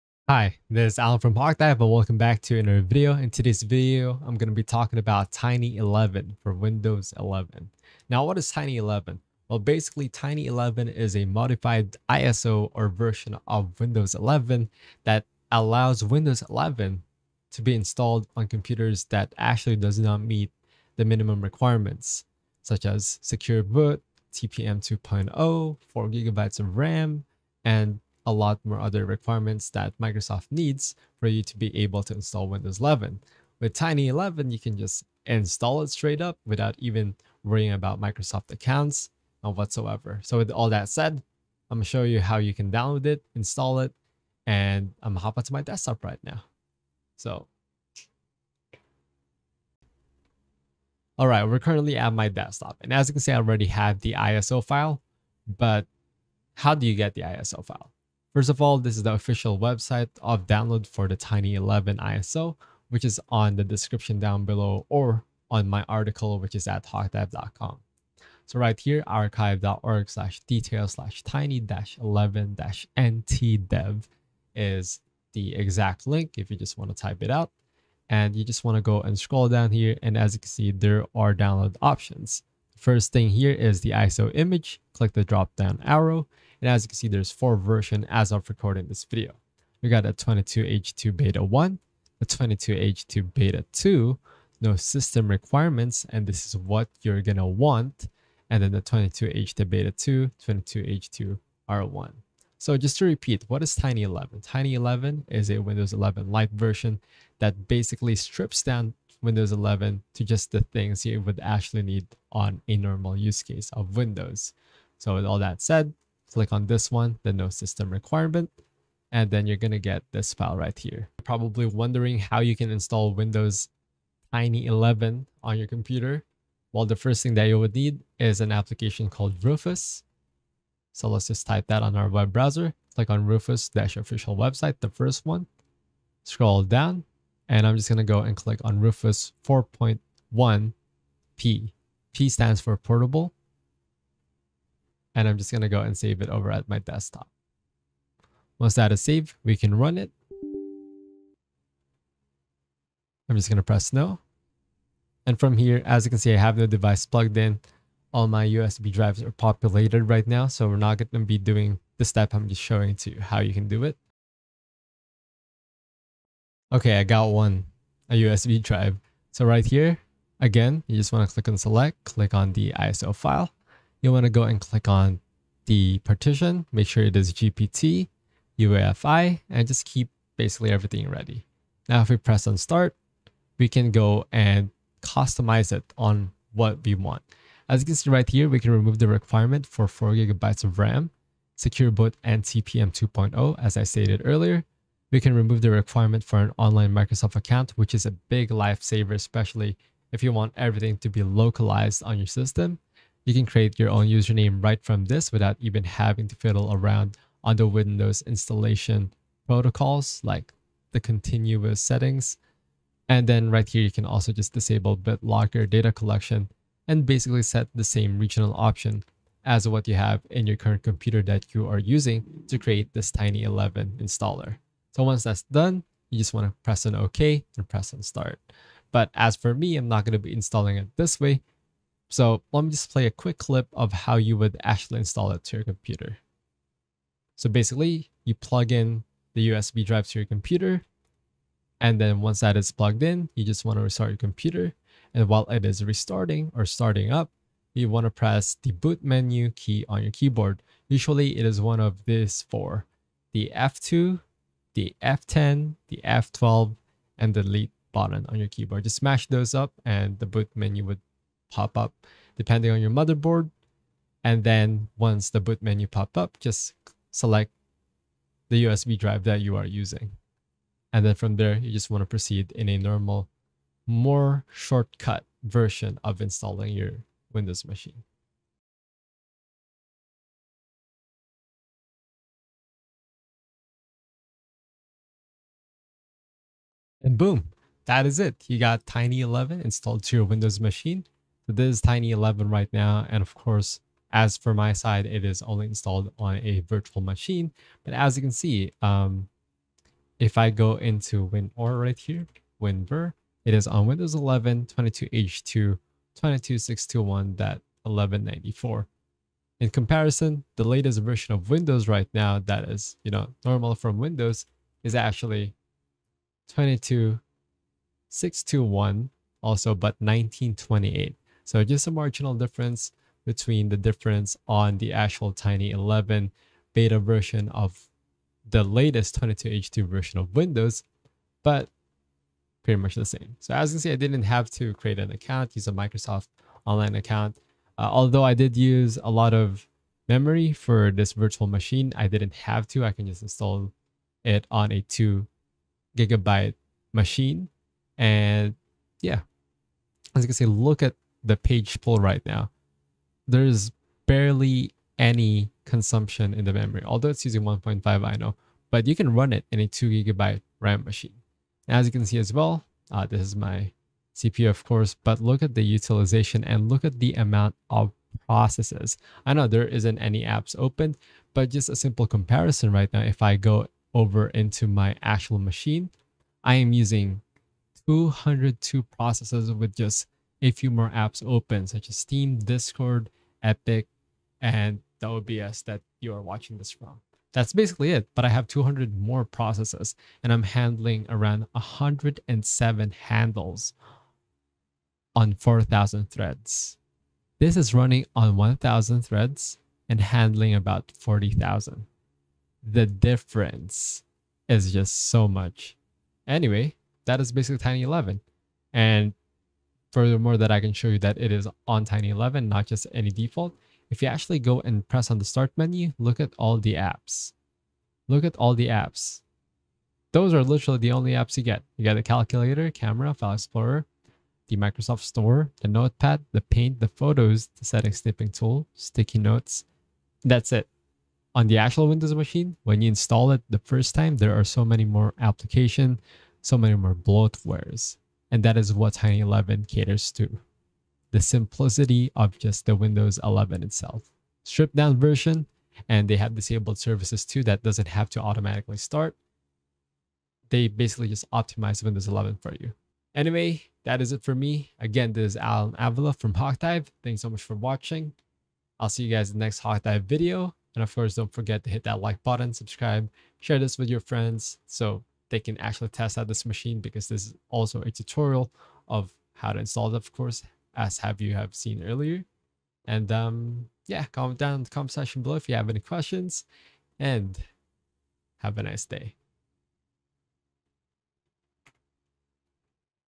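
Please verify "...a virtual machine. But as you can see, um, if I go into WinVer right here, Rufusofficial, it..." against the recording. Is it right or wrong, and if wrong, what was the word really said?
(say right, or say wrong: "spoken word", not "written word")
wrong: "WinVer", not "Rufusofficial".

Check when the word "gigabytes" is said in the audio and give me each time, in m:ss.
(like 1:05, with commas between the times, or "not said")
0:26, 3:10, 5:45, 5:59.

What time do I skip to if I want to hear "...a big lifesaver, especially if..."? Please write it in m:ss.
3:18.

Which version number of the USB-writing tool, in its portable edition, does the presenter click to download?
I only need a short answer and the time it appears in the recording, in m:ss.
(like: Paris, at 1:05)
4.1p, at 2:19.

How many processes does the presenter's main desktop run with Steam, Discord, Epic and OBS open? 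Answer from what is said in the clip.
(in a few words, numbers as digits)
202.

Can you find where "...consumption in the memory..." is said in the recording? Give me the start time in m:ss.
5:55.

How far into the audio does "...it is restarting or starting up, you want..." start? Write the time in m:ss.
4:05.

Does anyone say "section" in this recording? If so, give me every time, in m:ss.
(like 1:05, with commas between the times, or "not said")
7:54.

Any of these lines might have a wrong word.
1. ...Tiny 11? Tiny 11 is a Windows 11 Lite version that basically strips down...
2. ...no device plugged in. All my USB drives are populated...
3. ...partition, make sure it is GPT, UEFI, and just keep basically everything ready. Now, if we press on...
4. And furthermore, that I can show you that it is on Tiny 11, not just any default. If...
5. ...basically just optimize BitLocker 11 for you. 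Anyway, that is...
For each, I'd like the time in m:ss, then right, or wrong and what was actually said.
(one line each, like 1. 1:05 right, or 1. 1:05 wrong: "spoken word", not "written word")
1. 1:43 right
2. 2:36 right
3. 2:56 right
4. 6:48 right
5. 7:30 wrong: "Windows", not "BitLocker".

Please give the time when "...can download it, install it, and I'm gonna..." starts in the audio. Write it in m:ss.
0:42.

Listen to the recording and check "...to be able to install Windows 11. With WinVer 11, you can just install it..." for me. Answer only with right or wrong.
wrong.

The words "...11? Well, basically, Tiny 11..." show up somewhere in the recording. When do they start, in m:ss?
0:08.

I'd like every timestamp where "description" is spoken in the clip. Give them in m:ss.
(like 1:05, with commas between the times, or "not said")
1:03.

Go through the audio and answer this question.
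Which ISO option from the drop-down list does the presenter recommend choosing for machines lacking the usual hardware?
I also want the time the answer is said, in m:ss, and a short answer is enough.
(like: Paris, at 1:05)
no system requirements, at 1:34.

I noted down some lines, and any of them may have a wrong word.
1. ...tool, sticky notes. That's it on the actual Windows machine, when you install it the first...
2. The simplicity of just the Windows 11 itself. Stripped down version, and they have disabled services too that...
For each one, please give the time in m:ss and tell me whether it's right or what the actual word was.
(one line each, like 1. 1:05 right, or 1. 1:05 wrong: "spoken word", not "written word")
1. 7:08 right
2. 7:21 right.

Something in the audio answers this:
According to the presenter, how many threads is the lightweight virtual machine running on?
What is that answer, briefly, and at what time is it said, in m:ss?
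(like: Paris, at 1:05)
1,000, at 6:38.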